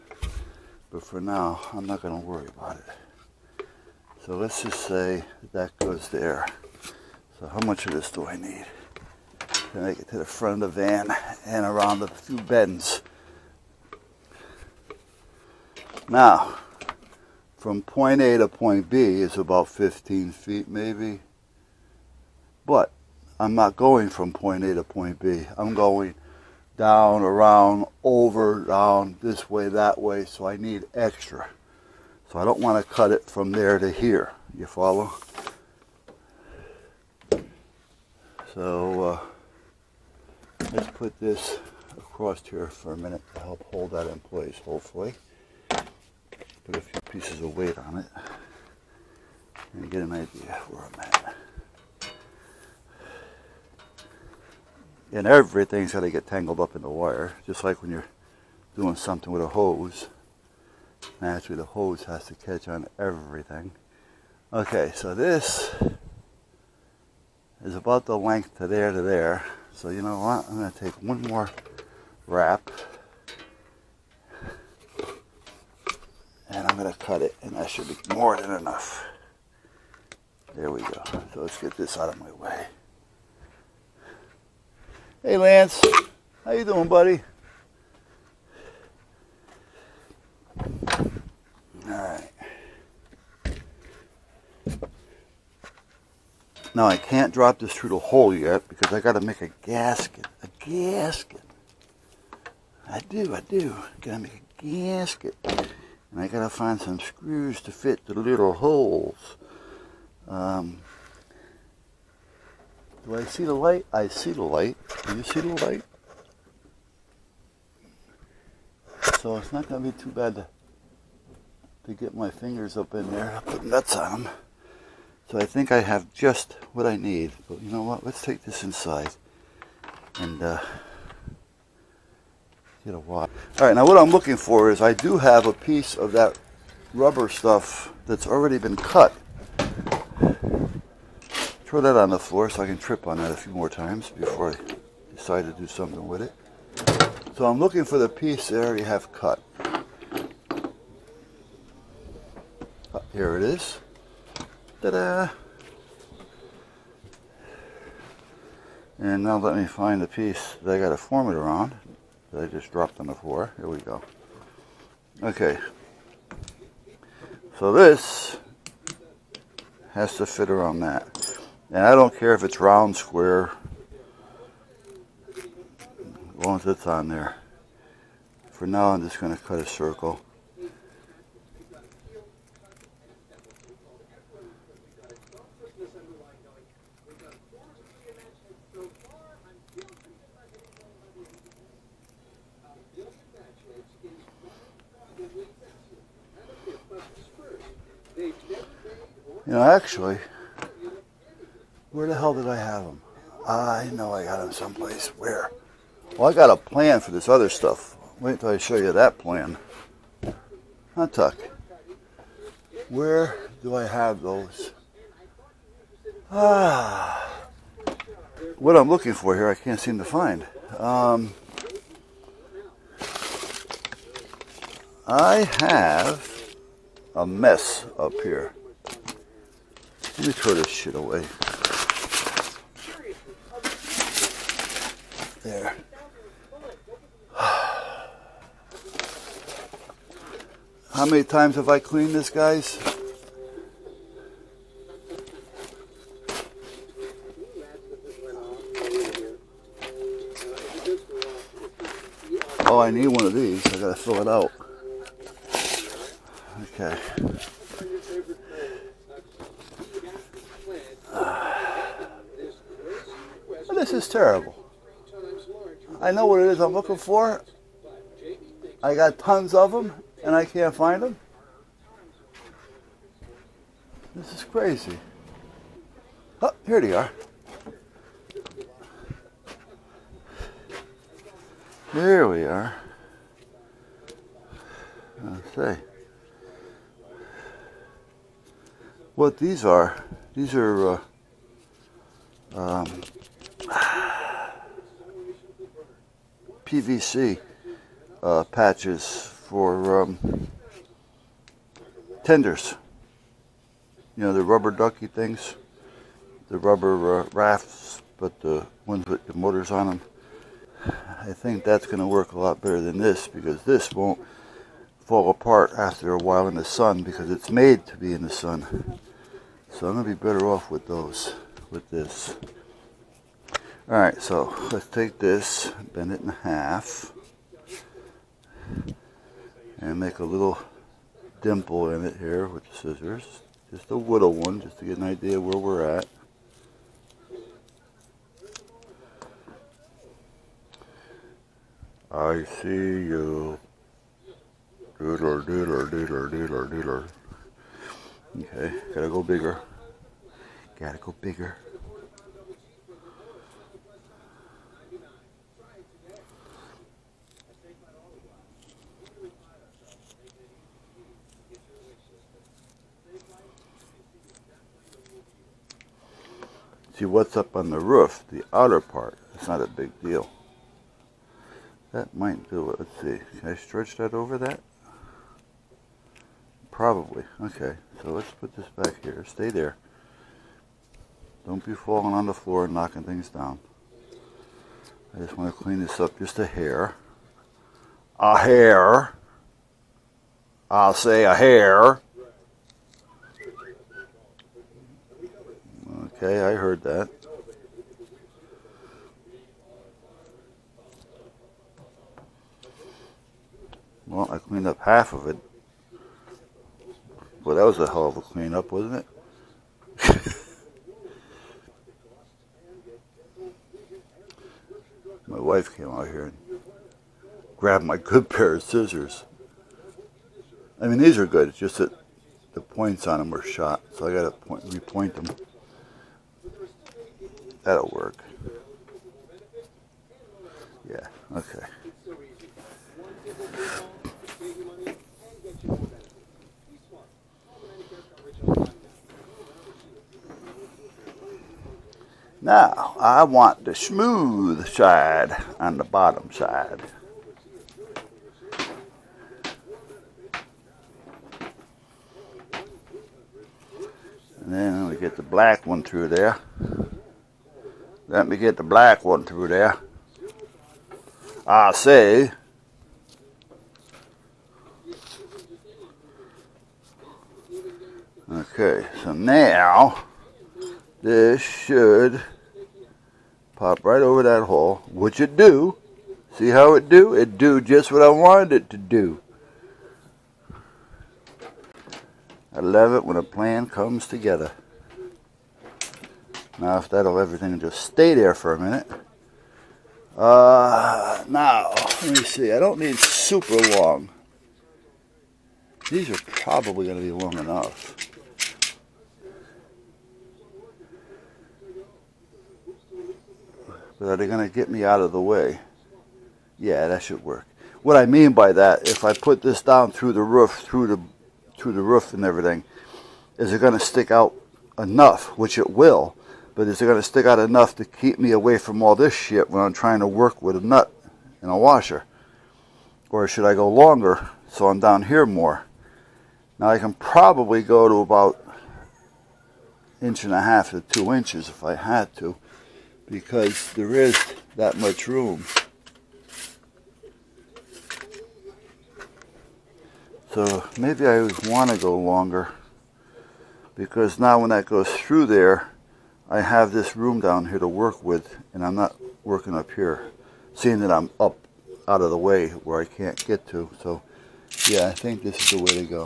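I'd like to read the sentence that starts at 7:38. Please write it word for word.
Let me get the black one through there.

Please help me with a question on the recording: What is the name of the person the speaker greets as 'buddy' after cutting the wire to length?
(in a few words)
Lance.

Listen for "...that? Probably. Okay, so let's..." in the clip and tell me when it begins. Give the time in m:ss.
6:14.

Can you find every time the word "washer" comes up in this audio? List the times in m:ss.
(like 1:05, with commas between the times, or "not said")
8:41.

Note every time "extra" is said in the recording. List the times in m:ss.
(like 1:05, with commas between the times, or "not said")
0:30.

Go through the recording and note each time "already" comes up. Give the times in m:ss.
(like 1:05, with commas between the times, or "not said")
2:18, 2:28.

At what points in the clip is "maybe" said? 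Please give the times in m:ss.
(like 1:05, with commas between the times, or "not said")
0:20, 9:00.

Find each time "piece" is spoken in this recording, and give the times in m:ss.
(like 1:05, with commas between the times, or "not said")
0:47, 2:15, 2:28, 2:40.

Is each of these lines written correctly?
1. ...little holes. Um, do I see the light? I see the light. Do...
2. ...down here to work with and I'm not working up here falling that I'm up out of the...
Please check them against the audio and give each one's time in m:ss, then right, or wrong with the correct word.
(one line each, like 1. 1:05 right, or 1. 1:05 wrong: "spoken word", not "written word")
1. 1:48 right
2. 9:07 wrong: "seeing", not "falling".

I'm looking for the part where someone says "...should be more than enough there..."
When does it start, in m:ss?
1:17.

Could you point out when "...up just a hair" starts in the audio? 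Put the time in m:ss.
6:25.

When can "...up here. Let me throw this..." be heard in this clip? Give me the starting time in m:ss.
3:47.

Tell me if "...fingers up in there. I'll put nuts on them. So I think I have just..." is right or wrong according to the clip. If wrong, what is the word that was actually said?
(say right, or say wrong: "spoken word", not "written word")
right.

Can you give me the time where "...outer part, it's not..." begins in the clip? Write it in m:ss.
6:08.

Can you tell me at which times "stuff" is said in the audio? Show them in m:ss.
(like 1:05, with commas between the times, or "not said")
2:17, 3:27.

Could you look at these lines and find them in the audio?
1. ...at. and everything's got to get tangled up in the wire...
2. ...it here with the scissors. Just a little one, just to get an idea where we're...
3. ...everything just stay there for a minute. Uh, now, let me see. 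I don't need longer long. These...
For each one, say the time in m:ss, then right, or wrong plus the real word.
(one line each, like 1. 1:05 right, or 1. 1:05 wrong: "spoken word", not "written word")
1. 0:51 right
2. 5:32 right
3. 8:07 wrong: "super", not "longer".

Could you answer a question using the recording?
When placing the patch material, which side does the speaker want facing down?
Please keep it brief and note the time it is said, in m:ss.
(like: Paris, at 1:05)
The smooth side, at 7:23.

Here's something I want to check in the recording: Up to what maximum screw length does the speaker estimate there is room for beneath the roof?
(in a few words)
2 inches.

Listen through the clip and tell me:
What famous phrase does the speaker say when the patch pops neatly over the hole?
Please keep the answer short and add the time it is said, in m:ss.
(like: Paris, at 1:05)
I love it when a plan comes together, at 8:02.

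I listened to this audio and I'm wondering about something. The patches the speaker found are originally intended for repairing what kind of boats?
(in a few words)
Tenders.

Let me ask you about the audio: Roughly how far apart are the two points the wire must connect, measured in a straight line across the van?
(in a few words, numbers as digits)
15 feet.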